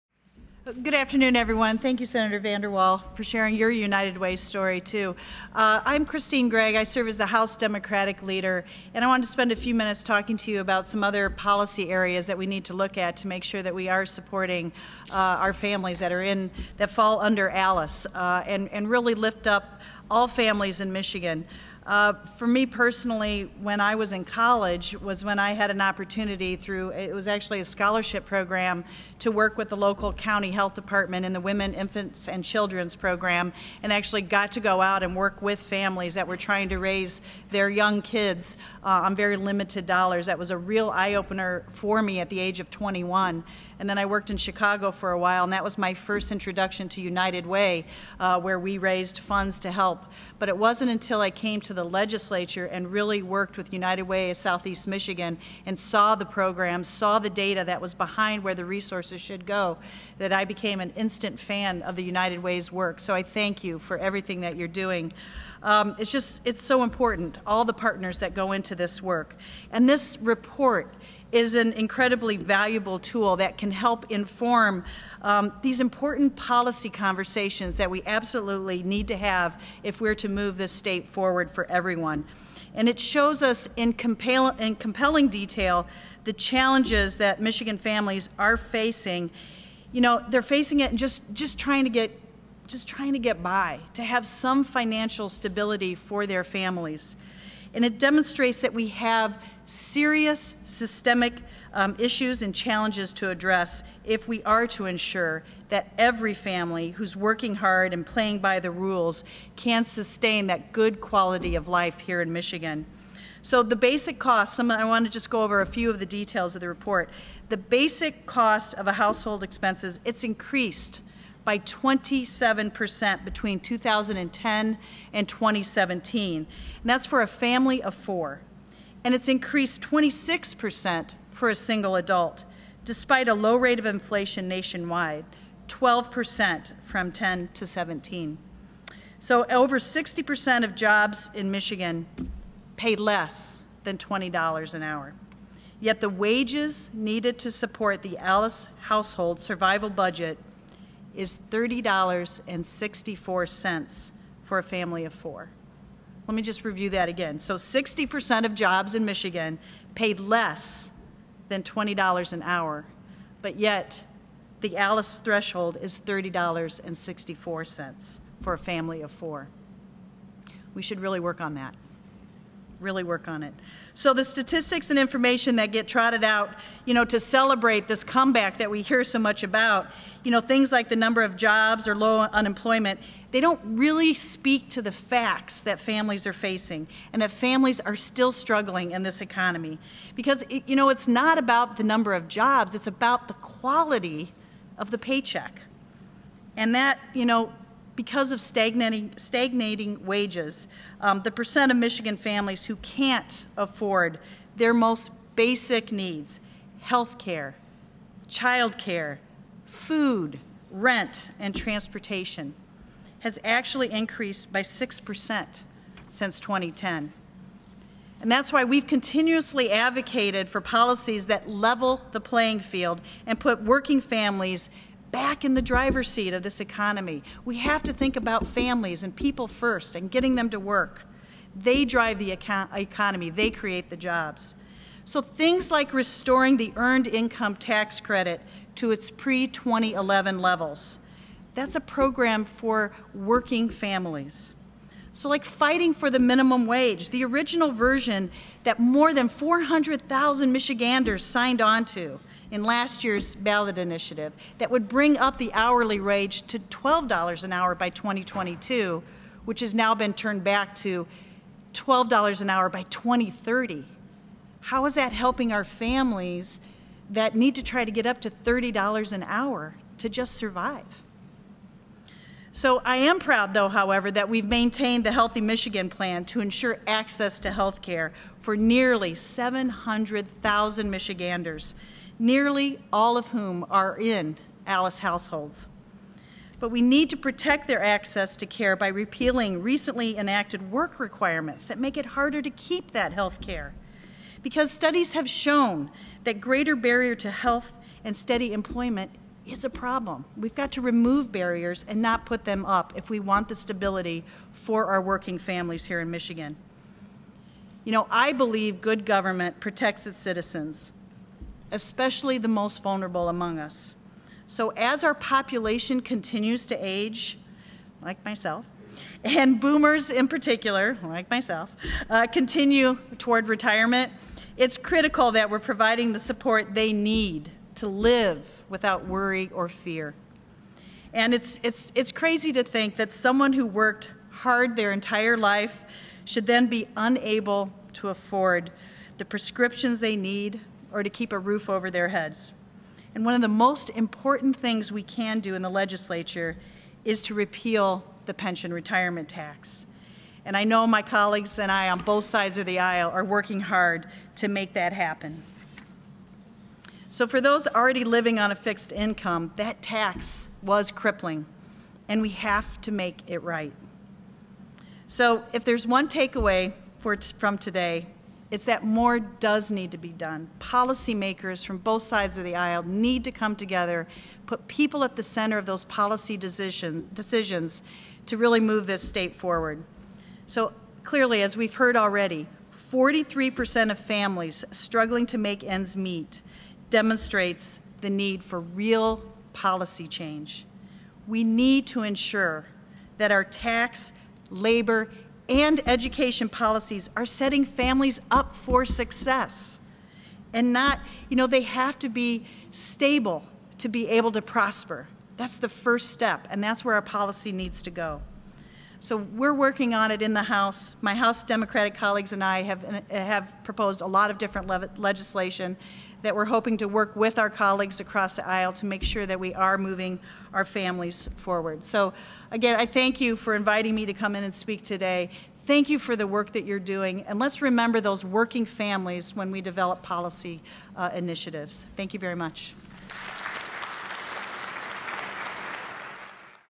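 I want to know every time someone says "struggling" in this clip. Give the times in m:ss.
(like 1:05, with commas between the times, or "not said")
3:08, 6:24.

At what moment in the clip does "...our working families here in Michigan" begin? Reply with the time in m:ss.
5:04.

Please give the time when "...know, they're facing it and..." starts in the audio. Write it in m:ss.
1:30.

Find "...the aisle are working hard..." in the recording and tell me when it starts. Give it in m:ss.
5:52.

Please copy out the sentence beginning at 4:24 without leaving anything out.
How is that helping our families that need to try to get up to $30 an hour to just survive?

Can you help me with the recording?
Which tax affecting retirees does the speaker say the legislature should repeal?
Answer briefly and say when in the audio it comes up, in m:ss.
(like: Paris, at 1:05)
pension retirement tax, at 5:48.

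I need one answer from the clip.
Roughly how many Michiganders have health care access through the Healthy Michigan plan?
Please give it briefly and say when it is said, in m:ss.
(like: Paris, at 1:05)
700,000, at 4:39.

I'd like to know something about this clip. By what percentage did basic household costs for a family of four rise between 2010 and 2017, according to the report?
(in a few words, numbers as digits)
27%.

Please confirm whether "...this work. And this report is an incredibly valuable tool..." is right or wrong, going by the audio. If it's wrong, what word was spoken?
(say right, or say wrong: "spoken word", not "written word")
right.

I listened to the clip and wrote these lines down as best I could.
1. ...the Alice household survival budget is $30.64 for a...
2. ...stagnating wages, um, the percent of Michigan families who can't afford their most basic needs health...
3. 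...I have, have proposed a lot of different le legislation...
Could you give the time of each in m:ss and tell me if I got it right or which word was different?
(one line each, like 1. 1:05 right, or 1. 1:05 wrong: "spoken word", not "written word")
1. 2:28 right
2. 3:19 right
3. 6:52 right.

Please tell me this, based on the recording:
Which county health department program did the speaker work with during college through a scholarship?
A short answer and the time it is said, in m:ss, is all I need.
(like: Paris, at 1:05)
Women, Infants, and Children's program, at 0:31.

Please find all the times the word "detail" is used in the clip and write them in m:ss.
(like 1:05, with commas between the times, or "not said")
1:25, 1:56.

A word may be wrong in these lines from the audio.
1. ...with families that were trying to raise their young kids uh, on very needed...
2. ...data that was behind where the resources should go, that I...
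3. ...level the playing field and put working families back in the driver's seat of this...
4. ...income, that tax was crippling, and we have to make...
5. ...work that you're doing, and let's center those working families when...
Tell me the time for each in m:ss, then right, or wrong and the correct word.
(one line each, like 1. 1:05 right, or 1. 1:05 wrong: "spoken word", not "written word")
1. 0:35 wrong: "limited", not "needed"
2. 0:57 right
3. 3:41 right
4. 5:58 right
5. 7:06 wrong: "remember", not "center".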